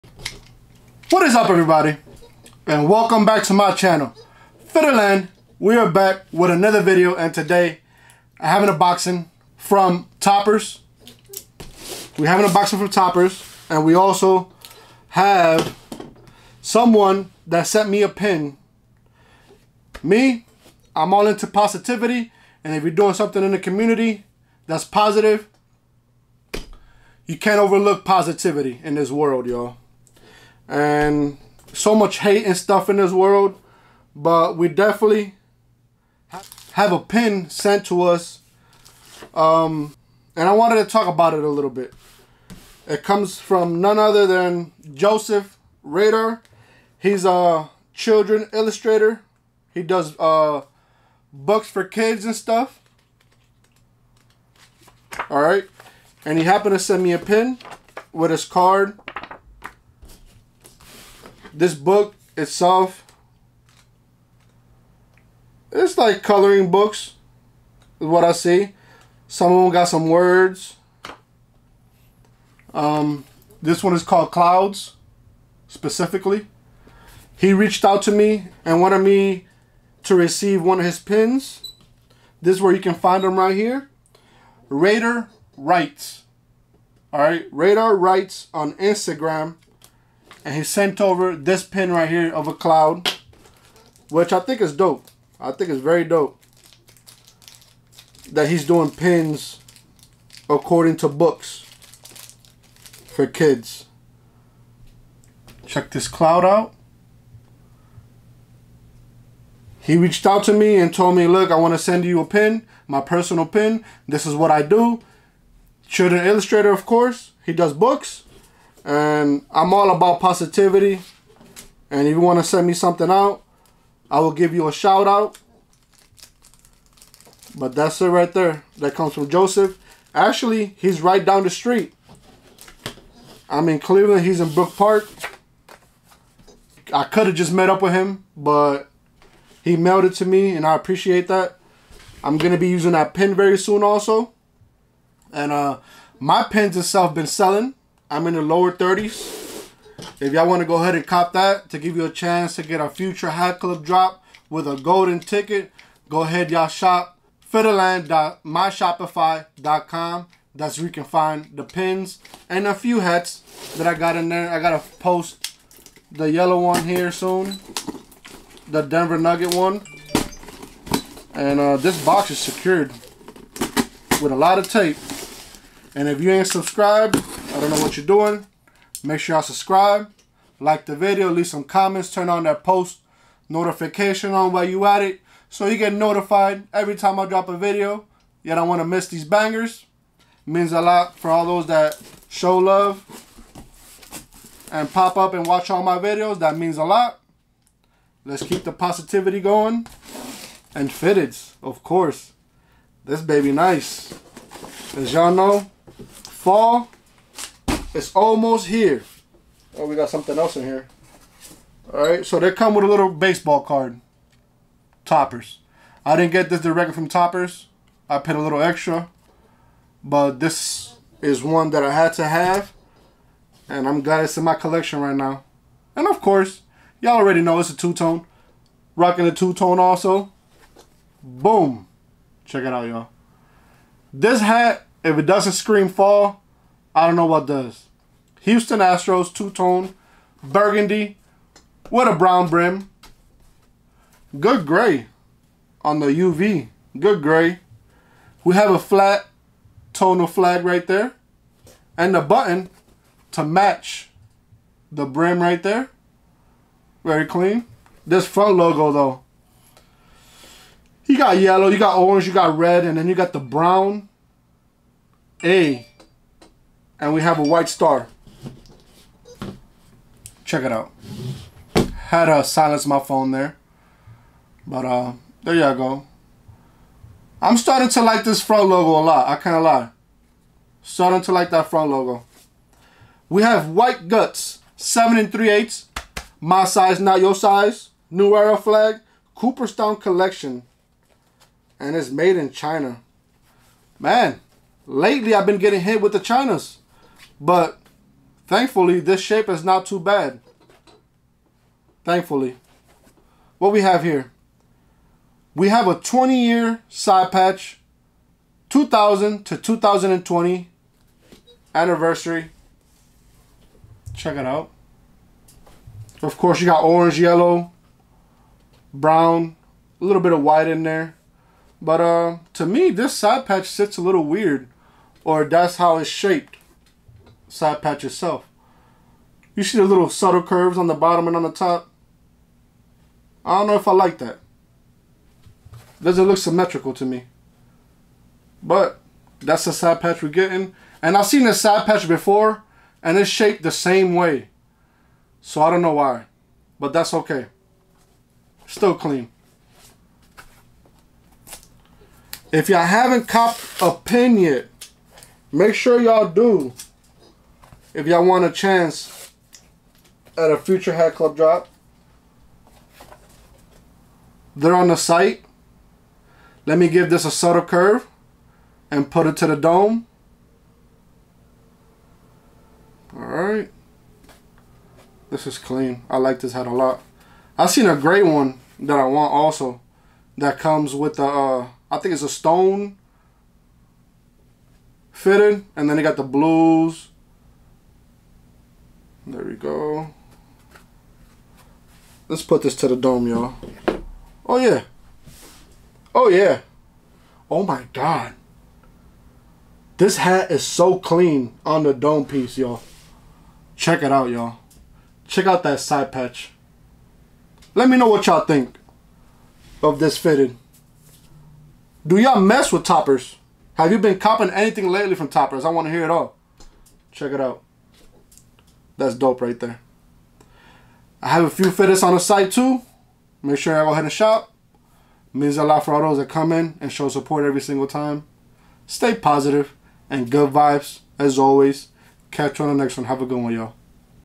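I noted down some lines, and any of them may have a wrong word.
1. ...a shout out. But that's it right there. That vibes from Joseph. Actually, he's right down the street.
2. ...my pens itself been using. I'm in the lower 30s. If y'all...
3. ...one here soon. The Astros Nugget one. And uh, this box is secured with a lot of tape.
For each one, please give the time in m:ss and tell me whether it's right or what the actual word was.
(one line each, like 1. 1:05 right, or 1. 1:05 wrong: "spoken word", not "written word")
1. 2:04 wrong: "comes", not "vibes"
2. 2:26 wrong: "selling", not "using"
3. 2:46 wrong: "Denver", not "Astros".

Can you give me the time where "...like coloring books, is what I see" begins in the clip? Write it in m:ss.
1:05.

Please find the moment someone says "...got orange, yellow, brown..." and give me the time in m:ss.
5:16.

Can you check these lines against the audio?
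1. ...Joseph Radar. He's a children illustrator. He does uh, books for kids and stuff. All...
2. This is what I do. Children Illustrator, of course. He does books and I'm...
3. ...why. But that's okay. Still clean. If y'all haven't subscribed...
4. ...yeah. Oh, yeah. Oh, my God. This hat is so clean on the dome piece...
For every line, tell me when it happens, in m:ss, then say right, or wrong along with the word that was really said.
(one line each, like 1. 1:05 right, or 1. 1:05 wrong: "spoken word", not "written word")
1. 0:44 right
2. 1:54 right
3. 5:45 wrong: "copped", not "subscribed"
4. 6:34 right.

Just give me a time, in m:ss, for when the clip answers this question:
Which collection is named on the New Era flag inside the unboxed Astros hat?
4:49.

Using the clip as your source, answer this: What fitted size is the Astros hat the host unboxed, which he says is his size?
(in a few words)
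7 3/8.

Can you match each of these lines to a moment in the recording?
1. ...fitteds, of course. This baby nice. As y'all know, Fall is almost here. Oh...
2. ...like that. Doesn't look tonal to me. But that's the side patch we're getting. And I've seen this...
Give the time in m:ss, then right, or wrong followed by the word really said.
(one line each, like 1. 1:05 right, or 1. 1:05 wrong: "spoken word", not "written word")
1. 3:20 right
2. 5:33 wrong: "symmetrical", not "tonal".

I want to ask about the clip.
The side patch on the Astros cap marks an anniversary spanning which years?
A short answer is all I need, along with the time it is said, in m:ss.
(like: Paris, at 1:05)
2000 to 2020, at 5:08.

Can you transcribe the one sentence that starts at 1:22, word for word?
This is where you can find them right here.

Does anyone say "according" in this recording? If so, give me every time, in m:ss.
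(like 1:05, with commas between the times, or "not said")
1:40.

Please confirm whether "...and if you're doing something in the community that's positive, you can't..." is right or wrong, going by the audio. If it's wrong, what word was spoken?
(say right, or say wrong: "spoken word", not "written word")
right.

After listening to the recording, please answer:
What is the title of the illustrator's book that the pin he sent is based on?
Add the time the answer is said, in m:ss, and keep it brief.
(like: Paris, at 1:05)
Clouds, at 1:14.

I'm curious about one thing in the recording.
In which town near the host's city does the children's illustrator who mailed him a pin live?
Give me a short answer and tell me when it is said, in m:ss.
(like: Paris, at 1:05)
Brook Park, at 2:14.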